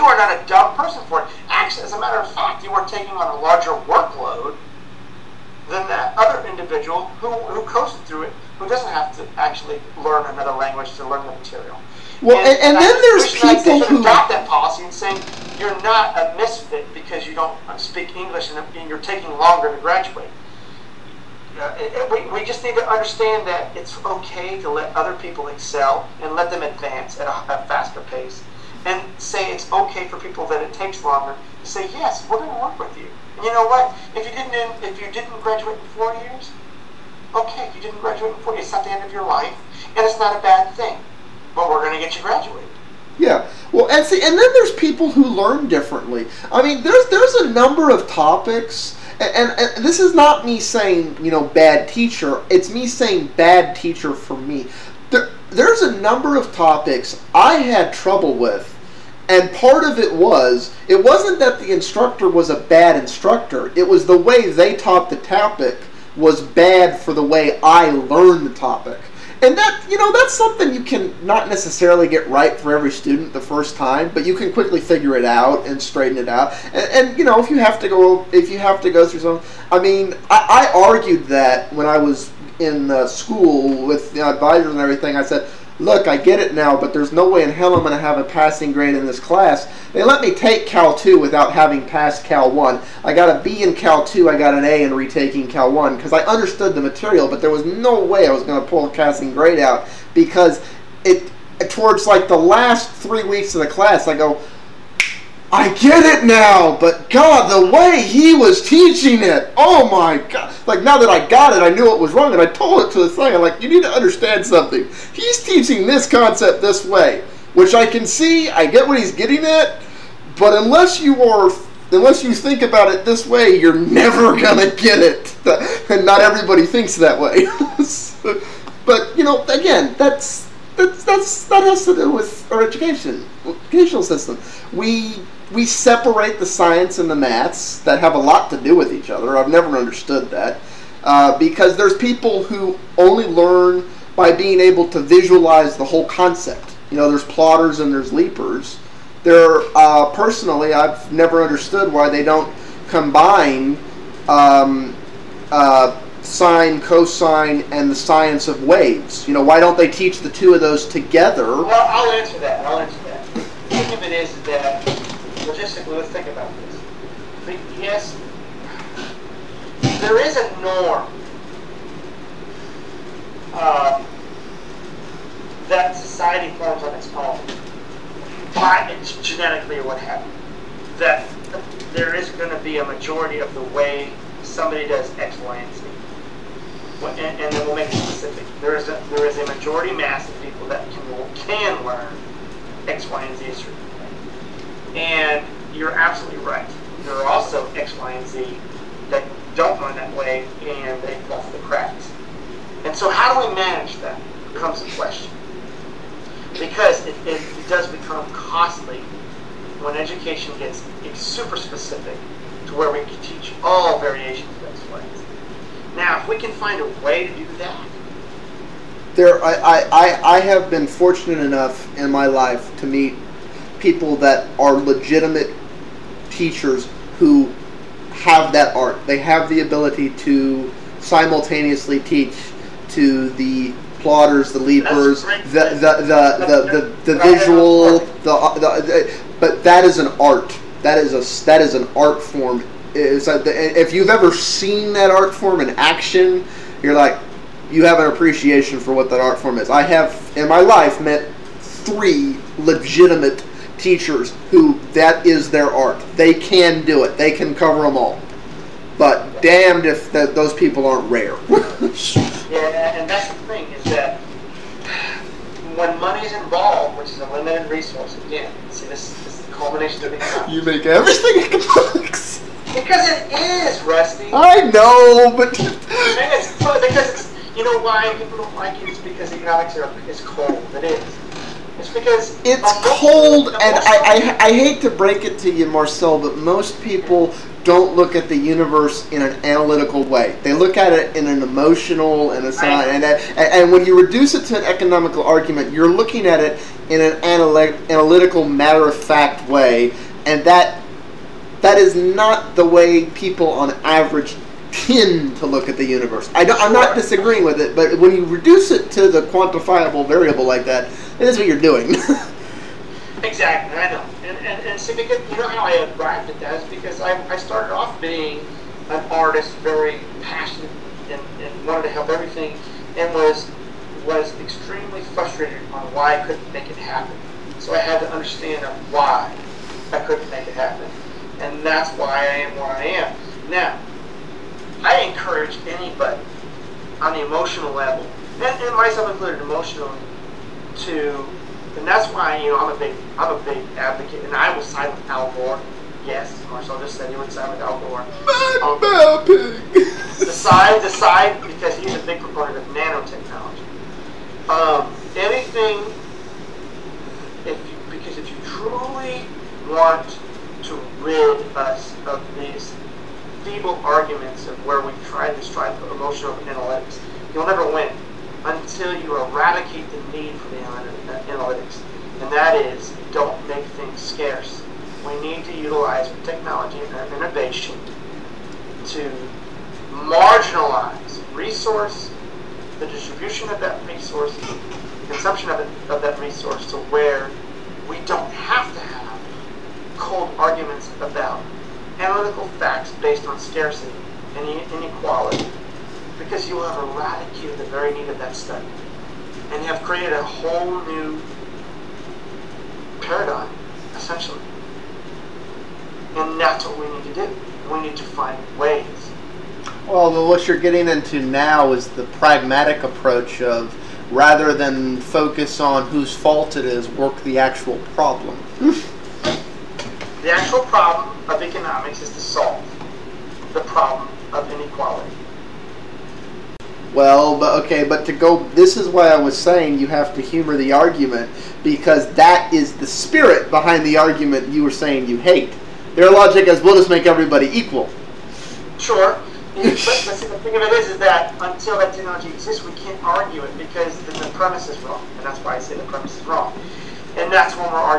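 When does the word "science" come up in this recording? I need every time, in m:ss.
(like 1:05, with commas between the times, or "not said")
2:16, 2:37.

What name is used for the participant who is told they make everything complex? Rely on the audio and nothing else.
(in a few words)
Rusty.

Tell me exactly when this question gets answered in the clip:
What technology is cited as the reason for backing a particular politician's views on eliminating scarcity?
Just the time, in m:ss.
5:52.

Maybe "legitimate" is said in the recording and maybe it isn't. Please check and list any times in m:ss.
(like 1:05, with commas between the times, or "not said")
3:44, 4:12.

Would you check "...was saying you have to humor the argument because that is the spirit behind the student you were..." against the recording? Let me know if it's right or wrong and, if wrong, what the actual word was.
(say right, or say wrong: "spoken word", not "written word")
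wrong: "argument", not "student".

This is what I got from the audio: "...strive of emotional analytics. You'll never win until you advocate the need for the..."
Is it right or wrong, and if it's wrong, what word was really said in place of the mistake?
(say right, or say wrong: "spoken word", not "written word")
wrong: "eradicate", not "advocate".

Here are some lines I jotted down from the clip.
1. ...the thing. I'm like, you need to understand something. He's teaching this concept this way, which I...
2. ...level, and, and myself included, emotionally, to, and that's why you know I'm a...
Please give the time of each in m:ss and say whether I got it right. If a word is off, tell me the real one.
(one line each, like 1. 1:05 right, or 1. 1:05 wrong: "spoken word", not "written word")
1. 1:52 right
2. 5:37 right.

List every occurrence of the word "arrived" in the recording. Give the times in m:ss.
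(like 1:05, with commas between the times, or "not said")
5:15.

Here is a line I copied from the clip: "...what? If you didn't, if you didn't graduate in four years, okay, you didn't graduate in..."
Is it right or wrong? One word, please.
right.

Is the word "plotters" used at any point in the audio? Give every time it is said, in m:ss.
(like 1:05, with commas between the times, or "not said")
2:27, 3:53.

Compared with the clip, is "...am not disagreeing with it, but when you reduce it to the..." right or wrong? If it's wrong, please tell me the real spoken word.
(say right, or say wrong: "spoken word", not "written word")
right.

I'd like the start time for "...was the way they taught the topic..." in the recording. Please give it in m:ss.
1:03.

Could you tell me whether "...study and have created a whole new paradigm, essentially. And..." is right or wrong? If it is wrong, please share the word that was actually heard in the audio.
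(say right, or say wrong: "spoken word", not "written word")
right.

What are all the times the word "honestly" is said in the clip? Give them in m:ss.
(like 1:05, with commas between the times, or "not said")
not said.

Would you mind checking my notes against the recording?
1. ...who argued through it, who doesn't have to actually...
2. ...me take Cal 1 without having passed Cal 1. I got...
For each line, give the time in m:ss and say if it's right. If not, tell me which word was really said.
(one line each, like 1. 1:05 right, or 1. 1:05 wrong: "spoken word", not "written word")
1. 0:07 wrong: "coasted", not "argued"
2. 1:30 wrong: "2", not "1".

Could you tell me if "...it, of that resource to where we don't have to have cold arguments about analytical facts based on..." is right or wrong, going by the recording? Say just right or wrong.
right.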